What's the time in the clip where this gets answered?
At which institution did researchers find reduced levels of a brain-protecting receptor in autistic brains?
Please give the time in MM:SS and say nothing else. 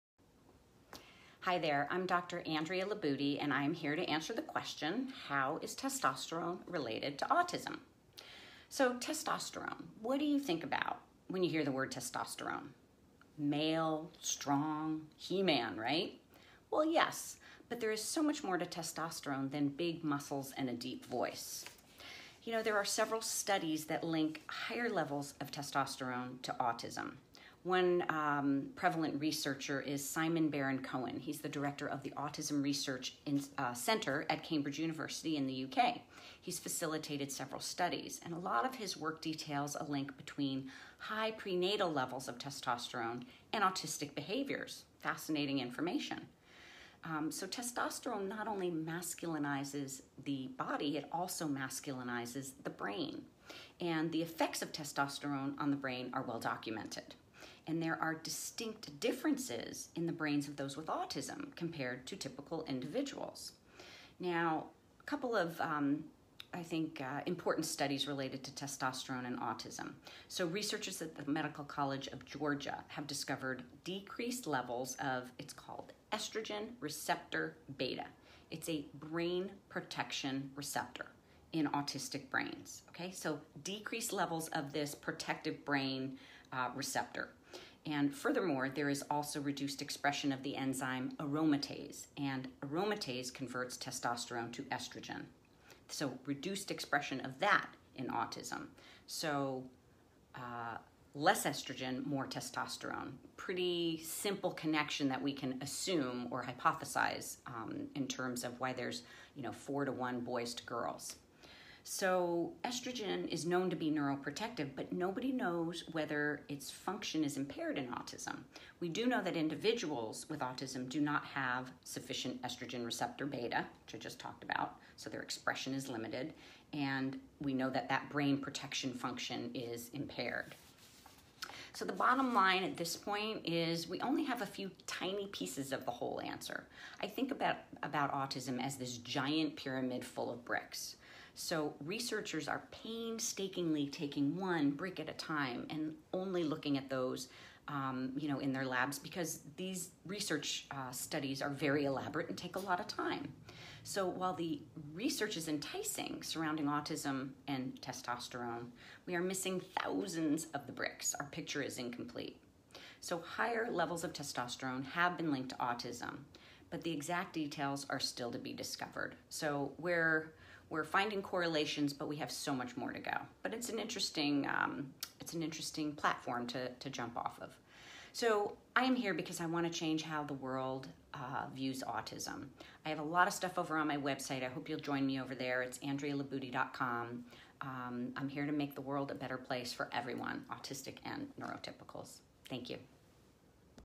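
01:11.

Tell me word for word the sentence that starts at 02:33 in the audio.
So while the research is enticing surrounding autism and testosterone, we are missing thousands of the bricks.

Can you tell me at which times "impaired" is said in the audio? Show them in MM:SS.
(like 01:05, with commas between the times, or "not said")
01:57, 02:09.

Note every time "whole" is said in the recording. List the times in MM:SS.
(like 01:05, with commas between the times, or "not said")
02:15.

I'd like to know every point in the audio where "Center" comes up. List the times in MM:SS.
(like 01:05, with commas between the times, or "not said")
00:33.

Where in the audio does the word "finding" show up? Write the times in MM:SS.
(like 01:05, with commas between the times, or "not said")
02:50.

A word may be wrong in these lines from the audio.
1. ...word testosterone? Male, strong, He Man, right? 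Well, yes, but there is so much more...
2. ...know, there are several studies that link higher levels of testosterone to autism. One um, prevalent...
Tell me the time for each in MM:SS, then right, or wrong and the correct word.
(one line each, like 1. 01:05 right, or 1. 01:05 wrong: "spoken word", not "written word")
1. 00:11 right
2. 00:22 right.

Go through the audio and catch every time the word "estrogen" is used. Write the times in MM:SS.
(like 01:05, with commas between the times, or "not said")
01:16, 01:34, 01:41, 01:52, 02:02.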